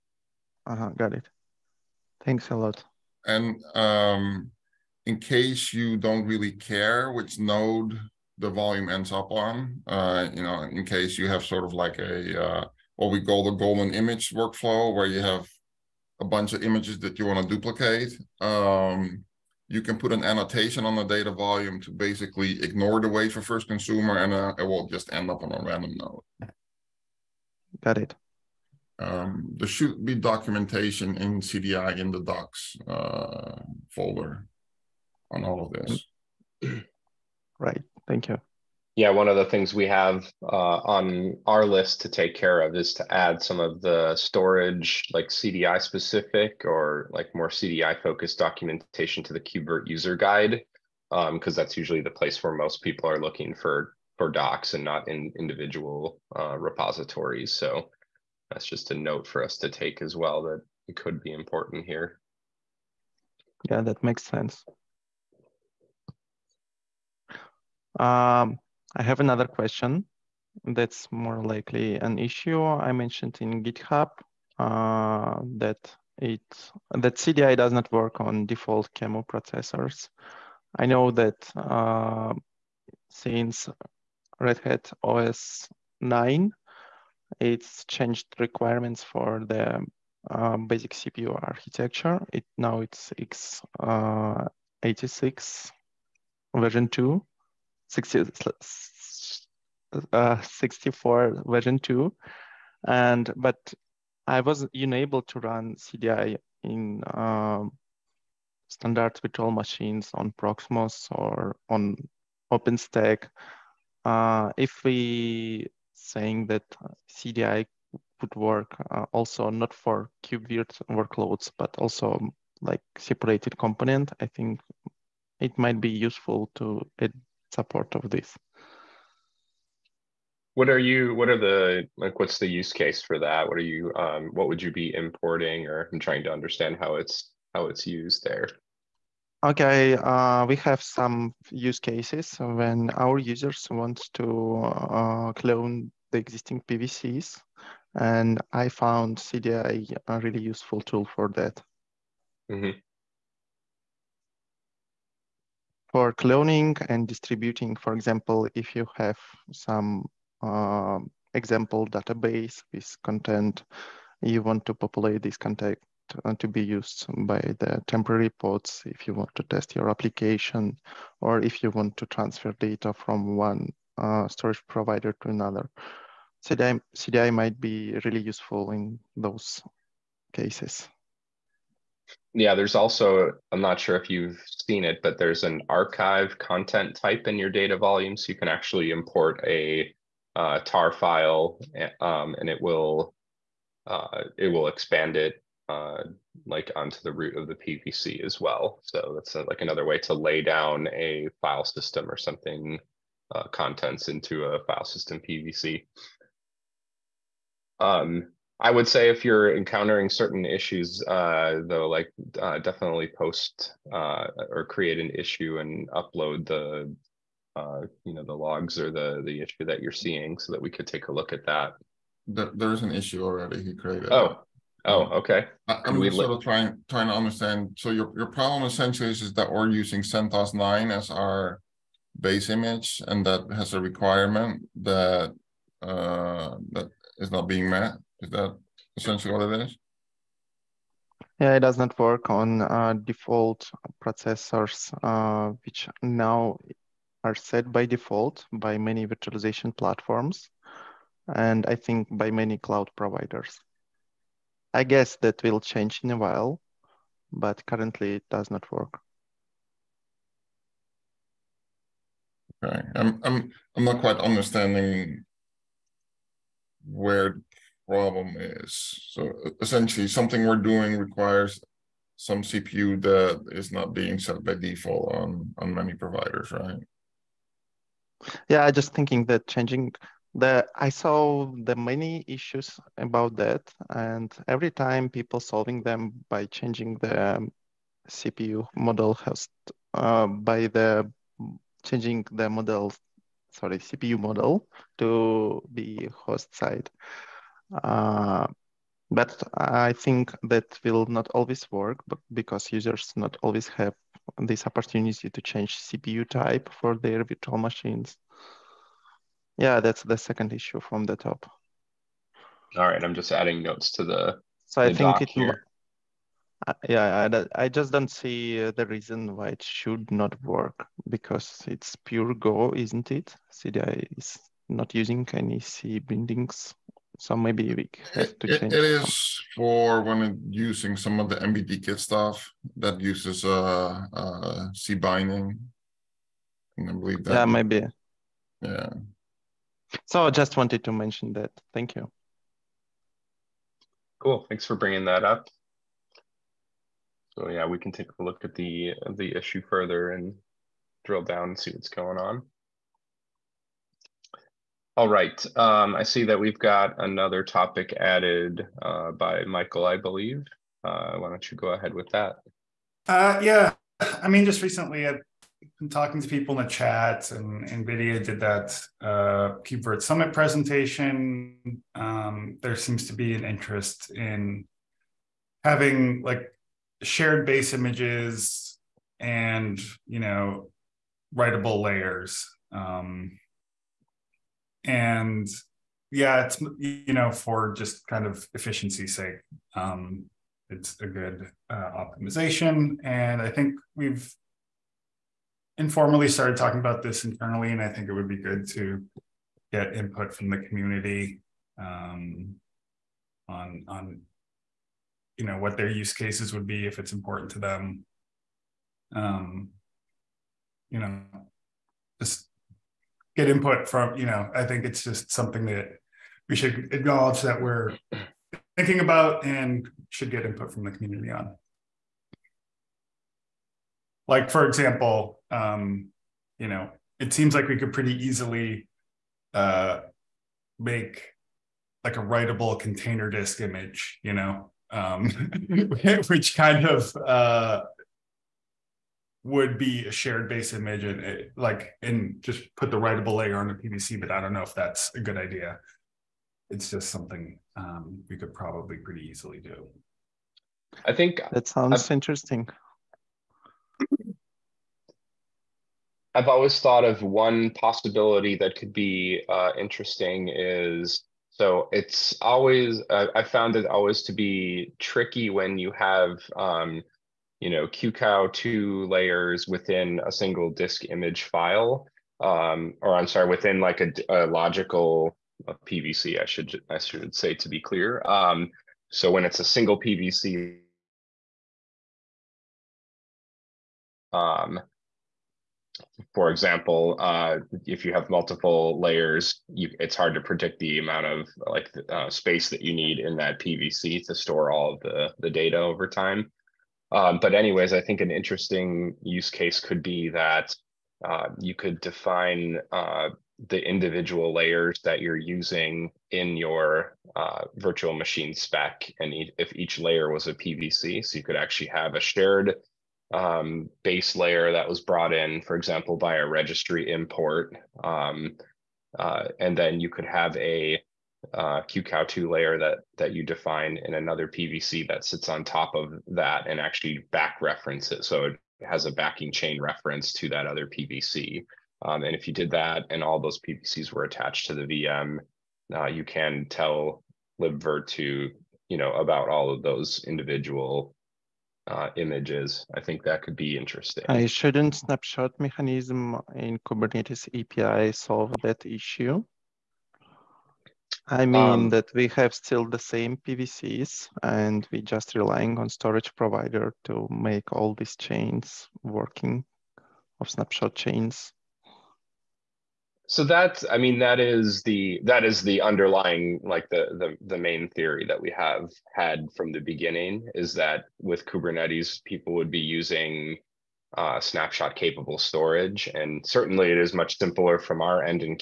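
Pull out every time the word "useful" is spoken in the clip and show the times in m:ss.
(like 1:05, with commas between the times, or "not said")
2:06, 2:30, 2:58.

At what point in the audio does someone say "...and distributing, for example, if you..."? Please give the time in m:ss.
2:36.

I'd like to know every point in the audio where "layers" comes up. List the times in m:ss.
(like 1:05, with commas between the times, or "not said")
6:21, 7:23, 7:49, 8:08, 8:24, 8:29, 8:34, 8:42.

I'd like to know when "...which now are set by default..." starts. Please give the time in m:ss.
4:05.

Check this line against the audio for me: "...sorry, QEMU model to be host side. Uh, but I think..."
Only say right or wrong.
wrong.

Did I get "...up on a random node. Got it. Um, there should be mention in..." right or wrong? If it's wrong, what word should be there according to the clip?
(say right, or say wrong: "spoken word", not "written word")
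wrong: "documentation", not "mention".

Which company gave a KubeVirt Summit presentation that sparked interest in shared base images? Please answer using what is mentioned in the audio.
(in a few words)
NVIDIA.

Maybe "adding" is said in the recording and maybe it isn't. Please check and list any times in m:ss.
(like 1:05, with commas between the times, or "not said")
5:13.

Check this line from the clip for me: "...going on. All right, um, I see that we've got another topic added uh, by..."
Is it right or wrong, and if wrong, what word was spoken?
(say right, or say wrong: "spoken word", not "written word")
right.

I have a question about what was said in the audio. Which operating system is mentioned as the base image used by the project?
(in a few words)
CentOS 9.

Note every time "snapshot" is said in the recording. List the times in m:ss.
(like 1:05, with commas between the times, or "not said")
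9:04, 9:20, 9:34.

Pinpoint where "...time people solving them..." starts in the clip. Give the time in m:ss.
4:44.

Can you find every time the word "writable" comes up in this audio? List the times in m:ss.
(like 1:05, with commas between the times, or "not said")
6:21, 7:12, 7:22.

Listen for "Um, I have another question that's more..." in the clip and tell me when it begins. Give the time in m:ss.
1:08.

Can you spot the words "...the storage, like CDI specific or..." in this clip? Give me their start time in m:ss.
0:43.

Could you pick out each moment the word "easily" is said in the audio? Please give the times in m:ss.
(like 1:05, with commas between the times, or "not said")
7:08, 7:29.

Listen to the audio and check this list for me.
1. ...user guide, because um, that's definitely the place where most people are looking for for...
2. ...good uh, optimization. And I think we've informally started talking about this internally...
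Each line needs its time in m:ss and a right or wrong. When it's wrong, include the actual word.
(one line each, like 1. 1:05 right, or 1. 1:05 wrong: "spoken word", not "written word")
1. 0:49 wrong: "usually", not "definitely"
2. 6:31 right.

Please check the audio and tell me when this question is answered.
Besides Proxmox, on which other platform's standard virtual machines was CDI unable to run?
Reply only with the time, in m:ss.
1:52.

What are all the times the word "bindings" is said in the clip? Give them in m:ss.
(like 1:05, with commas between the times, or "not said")
5:25, 5:34.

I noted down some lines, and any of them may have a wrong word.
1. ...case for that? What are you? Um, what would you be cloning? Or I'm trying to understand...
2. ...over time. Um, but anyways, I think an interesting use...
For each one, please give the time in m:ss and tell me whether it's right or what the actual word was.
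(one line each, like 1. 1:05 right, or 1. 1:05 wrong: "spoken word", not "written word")
1. 2:12 wrong: "importing", not "cloning"
2. 8:15 right.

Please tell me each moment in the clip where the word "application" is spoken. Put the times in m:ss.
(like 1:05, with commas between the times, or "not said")
2:49.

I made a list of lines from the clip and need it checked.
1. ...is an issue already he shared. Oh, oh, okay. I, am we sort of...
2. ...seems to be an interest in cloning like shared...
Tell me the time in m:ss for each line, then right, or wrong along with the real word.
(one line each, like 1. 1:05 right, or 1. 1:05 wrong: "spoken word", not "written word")
1. 3:42 wrong: "created", not "shared"
2. 6:12 wrong: "having", not "cloning".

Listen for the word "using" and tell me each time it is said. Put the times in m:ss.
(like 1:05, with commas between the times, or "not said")
3:49, 5:24, 5:30, 8:25, 9:32.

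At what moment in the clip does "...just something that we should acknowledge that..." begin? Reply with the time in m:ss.
6:55.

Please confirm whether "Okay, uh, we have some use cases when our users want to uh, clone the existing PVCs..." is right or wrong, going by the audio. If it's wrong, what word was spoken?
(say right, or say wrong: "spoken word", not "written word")
right.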